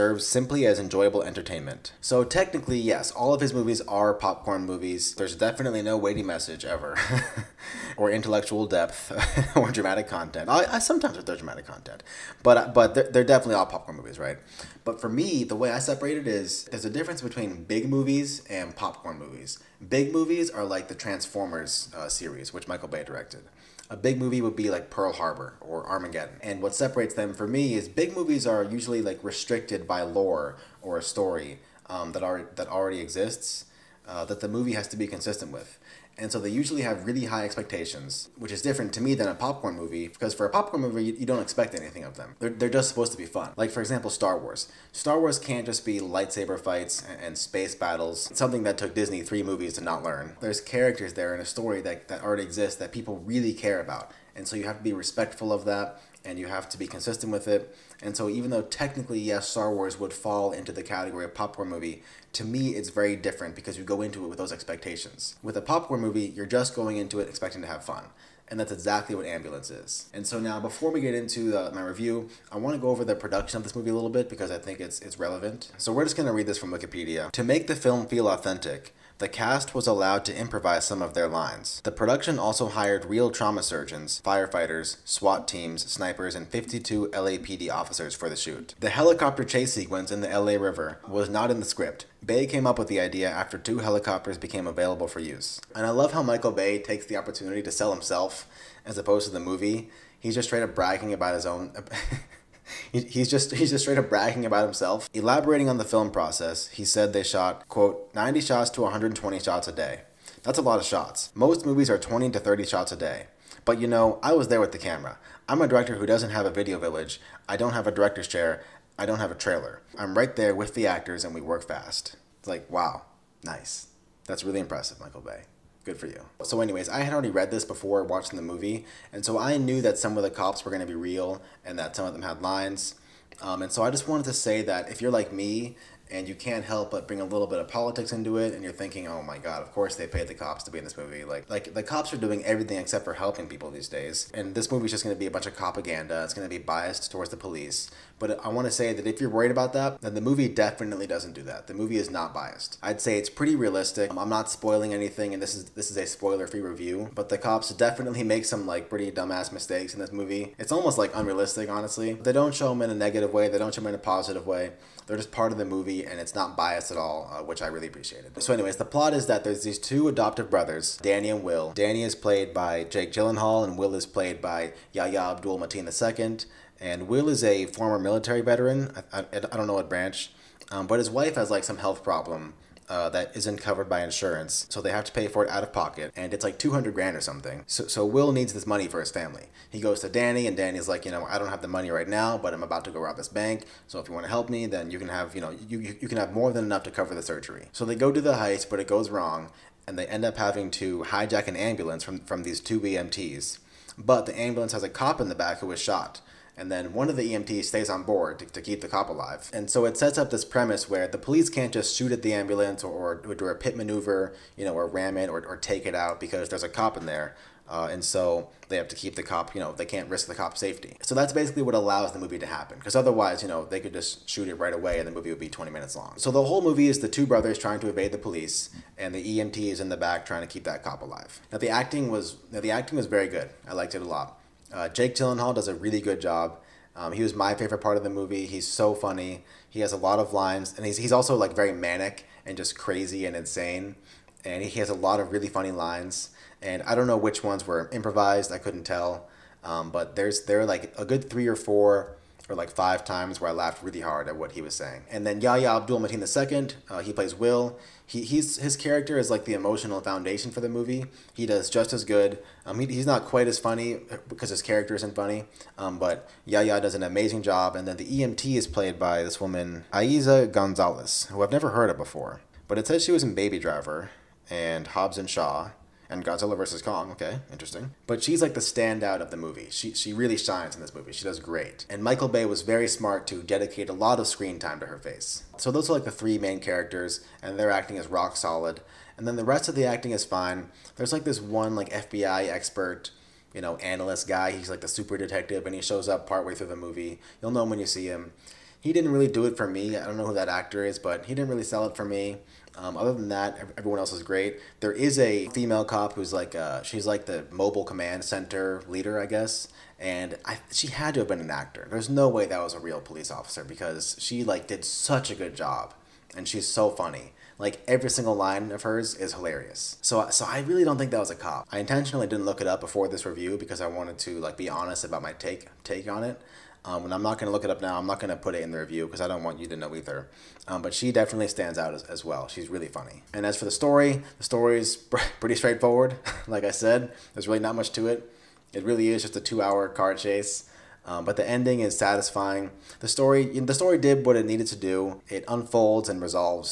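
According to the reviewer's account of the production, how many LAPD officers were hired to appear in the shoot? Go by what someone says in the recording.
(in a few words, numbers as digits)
52.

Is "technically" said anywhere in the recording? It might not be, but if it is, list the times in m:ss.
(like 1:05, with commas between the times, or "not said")
0:02, 0:58.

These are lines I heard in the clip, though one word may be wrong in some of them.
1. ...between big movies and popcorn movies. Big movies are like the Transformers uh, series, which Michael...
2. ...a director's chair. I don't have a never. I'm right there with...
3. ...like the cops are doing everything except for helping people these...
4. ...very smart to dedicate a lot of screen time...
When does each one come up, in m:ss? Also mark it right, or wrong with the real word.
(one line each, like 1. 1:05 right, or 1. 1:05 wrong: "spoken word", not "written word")
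1. 0:17 right
2. 1:57 wrong: "trailer", not "never"
3. 2:21 right
4. 4:42 right.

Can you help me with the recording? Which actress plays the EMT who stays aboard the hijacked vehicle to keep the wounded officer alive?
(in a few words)
Eiza Gonzalez.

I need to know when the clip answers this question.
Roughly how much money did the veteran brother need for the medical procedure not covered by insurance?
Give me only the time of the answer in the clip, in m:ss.
3:06.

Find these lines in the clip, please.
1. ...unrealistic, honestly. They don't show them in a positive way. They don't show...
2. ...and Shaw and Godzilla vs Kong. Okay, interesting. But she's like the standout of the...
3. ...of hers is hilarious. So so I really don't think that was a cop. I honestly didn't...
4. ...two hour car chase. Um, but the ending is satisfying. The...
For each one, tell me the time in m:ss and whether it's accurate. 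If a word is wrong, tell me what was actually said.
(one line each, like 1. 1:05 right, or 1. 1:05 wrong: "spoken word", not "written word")
1. 2:41 wrong: "negative", not "positive"
2. 4:35 right
3. 5:18 wrong: "intentionally", not "honestly"
4. 5:39 right.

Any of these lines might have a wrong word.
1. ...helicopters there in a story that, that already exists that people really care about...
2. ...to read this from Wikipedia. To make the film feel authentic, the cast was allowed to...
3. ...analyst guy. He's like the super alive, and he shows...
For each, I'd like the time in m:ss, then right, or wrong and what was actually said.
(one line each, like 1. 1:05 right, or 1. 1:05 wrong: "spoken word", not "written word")
1. 0:50 wrong: "characters", not "helicopters"
2. 1:16 right
3. 4:53 wrong: "detective", not "alive".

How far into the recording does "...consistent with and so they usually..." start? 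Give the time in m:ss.
0:35.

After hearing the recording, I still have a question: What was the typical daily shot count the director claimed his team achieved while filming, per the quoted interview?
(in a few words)
90 to 120.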